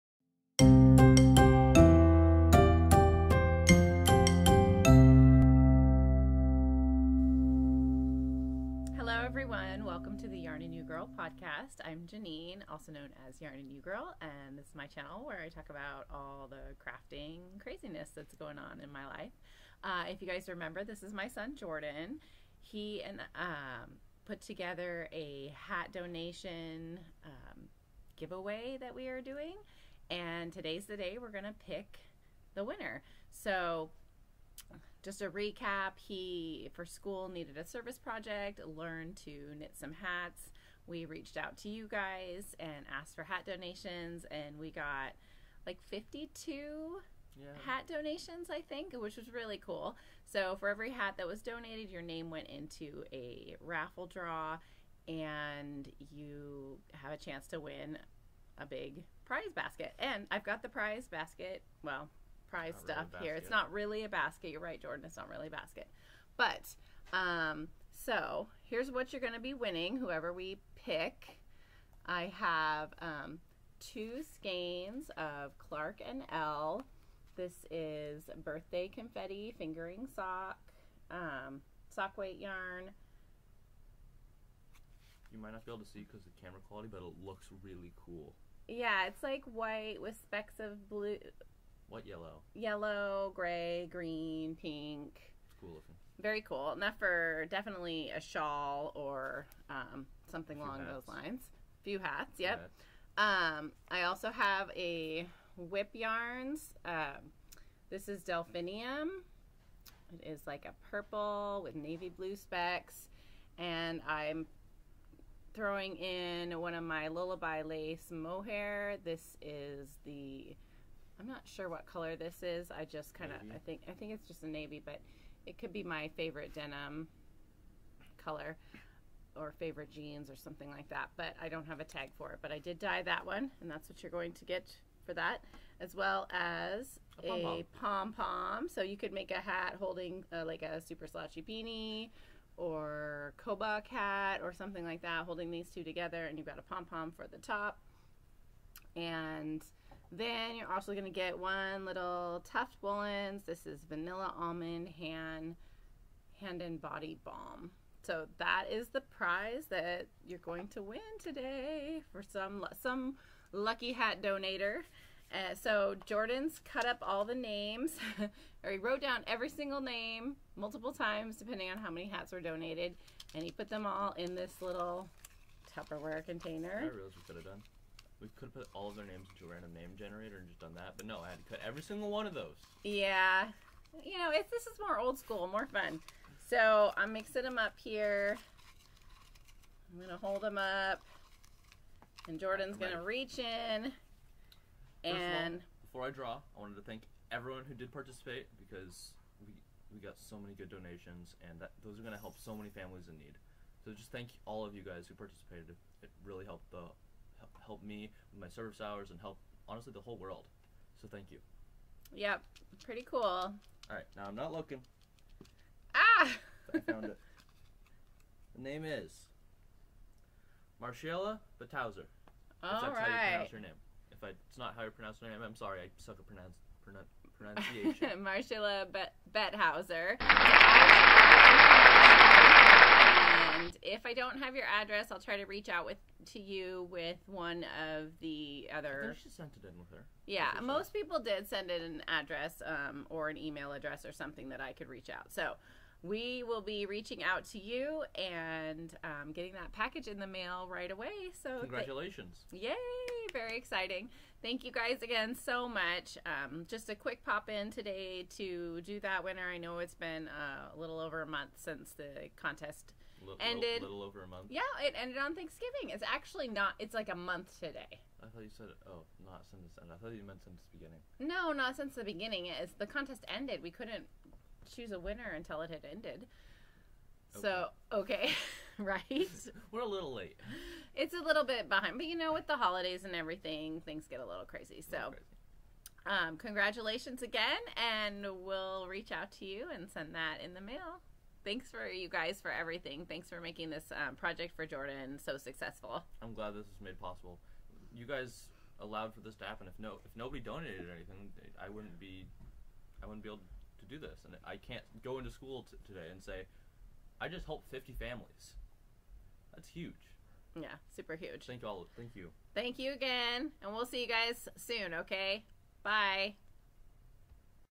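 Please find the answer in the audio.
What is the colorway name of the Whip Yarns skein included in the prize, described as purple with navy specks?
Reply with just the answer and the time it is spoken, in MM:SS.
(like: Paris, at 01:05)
Delphinium, at 01:48.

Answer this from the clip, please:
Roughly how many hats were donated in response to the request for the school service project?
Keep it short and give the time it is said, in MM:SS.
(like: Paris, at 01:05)
52, at 00:45.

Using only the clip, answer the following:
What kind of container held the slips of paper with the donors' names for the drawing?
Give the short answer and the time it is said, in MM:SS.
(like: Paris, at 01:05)
Tupperware container, at 02:55.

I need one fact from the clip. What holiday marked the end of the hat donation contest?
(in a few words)
Thanksgiving.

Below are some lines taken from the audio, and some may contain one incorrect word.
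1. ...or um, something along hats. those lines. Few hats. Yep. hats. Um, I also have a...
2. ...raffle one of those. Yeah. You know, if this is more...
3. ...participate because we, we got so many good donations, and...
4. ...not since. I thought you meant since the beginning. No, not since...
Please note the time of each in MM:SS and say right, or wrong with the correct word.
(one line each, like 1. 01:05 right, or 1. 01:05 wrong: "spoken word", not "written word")
1. 01:38 right
2. 03:01 wrong: "single", not "raffle"
3. 03:17 right
4. 04:29 right.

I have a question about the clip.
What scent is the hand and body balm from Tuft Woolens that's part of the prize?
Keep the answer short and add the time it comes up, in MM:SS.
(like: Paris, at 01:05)
Vanilla Almond, at 02:33.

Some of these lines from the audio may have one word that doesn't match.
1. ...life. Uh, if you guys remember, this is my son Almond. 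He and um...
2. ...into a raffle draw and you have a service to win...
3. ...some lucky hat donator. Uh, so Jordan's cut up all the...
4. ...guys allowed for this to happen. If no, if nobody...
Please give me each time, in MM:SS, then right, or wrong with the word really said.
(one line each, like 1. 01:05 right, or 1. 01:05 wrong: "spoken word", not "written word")
1. 00:19 wrong: "Jordan", not "Almond"
2. 00:52 wrong: "chance", not "service"
3. 02:42 right
4. 04:58 right.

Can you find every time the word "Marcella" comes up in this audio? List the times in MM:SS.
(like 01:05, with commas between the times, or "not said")
03:40, 03:48.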